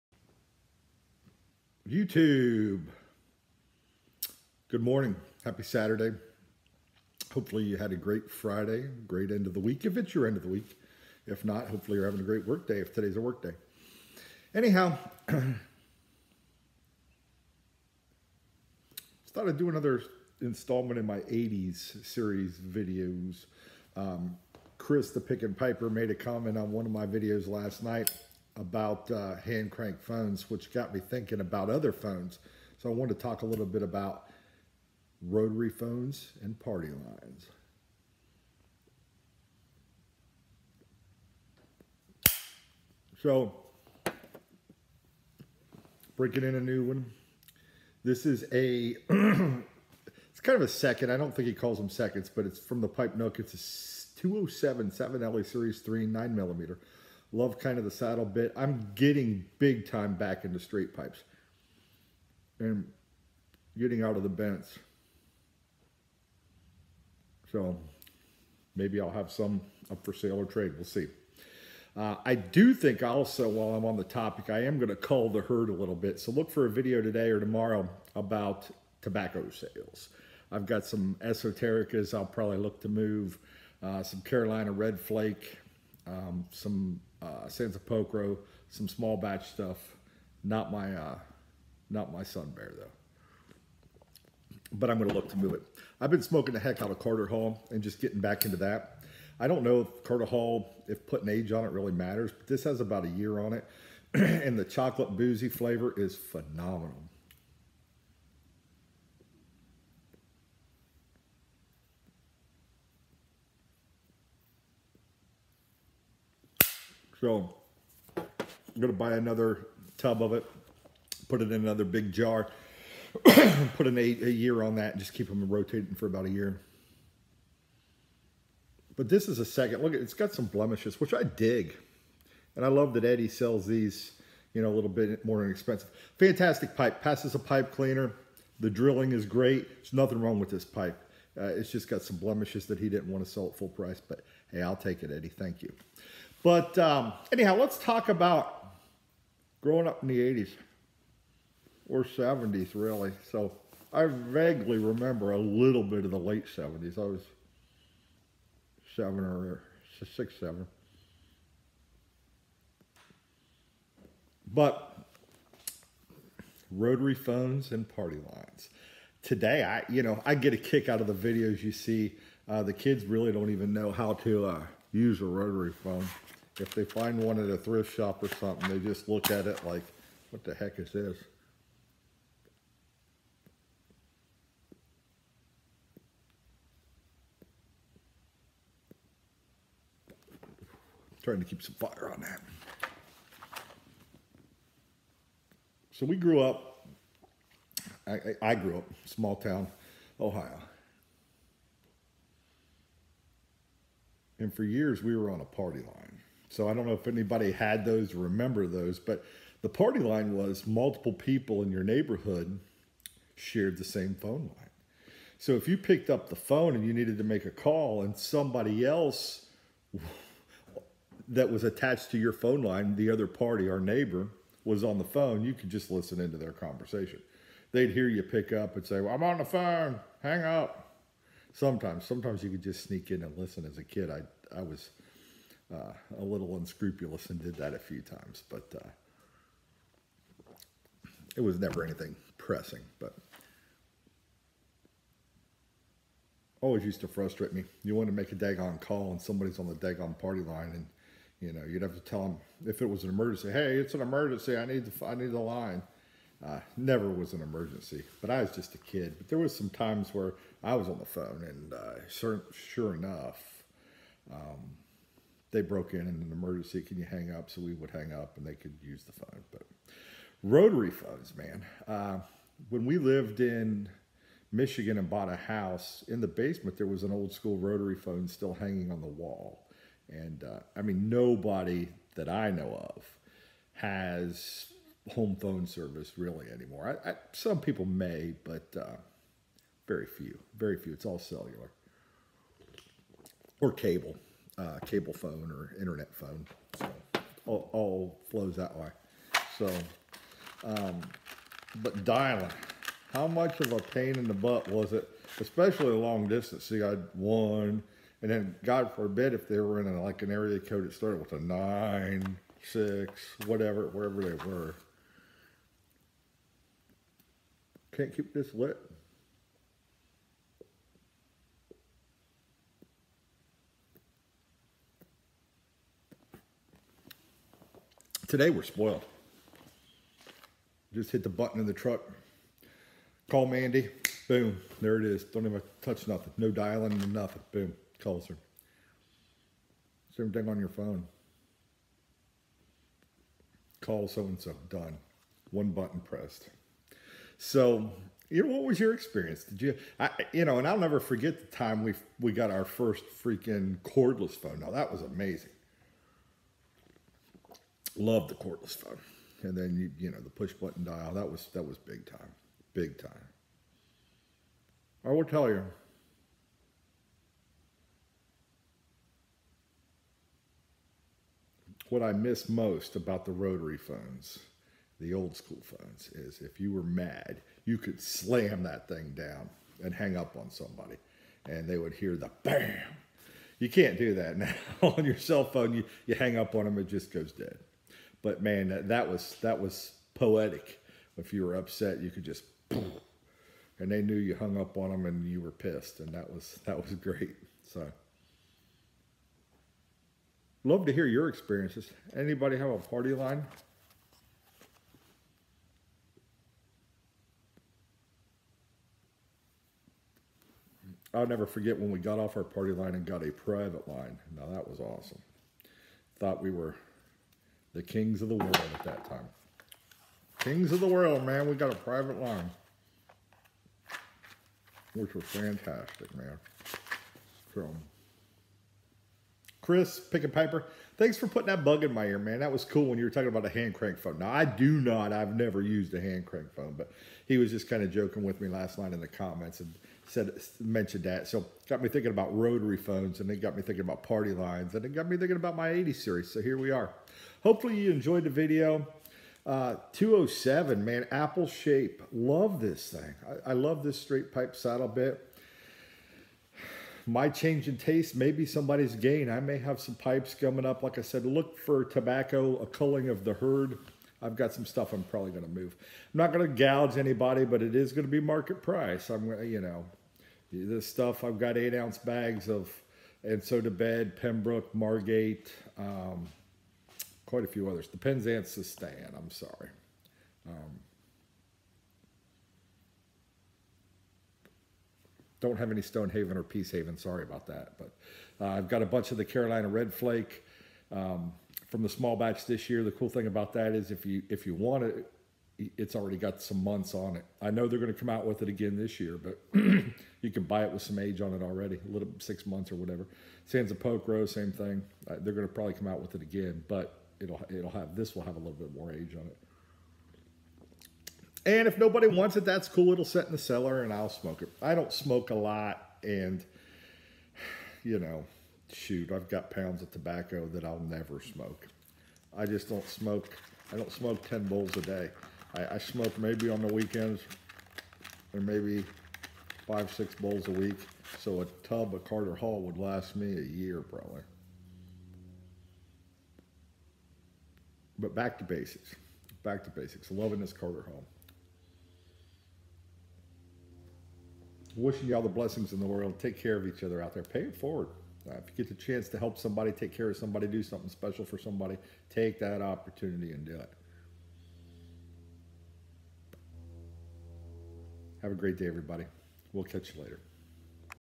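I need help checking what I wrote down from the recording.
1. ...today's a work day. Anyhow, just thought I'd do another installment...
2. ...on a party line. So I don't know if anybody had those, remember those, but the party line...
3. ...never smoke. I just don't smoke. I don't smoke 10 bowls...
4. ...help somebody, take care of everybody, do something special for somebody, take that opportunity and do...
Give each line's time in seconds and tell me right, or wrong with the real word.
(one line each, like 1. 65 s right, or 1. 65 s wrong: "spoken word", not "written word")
1. 12 s right
2. 205 s right
3. 520 s right
4. 549 s wrong: "somebody", not "everybody".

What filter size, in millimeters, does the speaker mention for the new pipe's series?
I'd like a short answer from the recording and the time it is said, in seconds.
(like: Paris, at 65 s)
9 millimeter, at 56 s.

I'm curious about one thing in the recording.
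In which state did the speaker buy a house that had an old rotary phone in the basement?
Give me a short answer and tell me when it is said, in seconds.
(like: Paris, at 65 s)
Michigan, at 274 s.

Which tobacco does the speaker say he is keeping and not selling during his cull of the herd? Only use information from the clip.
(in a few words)
Sun Bear.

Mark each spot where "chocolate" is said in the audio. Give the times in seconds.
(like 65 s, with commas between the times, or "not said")
104 s.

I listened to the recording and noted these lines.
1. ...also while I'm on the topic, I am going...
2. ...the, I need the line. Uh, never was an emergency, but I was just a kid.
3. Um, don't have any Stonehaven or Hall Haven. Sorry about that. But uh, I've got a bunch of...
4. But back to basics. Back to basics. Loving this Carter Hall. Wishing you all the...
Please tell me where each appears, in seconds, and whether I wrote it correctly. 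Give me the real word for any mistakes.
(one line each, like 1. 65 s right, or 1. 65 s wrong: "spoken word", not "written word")
1. 73 s right
2. 254 s right
3. 480 s wrong: "Peace", not "Hall"
4. 537 s right.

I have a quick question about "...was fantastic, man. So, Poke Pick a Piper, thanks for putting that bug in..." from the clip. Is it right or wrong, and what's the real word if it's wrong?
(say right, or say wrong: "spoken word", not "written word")
wrong: "Chris", not "Poke".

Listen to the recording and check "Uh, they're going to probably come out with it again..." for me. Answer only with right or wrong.
right.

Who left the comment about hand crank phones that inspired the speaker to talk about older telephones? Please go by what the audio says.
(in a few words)
Chris the Pick and Piper.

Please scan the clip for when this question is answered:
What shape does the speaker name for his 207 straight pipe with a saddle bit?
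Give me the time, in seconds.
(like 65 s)
451 s.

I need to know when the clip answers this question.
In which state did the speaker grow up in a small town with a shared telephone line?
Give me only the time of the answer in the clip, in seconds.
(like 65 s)
200 s.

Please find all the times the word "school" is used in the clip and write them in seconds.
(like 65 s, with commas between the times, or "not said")
277 s, 375 s.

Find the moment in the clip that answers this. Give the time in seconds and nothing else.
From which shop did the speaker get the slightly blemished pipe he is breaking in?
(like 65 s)
52 s.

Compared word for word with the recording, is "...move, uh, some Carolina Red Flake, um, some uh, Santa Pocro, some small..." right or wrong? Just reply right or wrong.
right.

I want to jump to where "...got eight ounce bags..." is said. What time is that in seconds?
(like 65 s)
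471 s.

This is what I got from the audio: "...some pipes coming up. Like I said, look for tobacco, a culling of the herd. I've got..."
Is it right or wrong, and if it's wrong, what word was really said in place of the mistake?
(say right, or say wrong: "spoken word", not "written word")
right.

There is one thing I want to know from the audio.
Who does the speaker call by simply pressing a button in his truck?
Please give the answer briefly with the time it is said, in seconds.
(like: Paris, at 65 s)
Mandy, at 333 s.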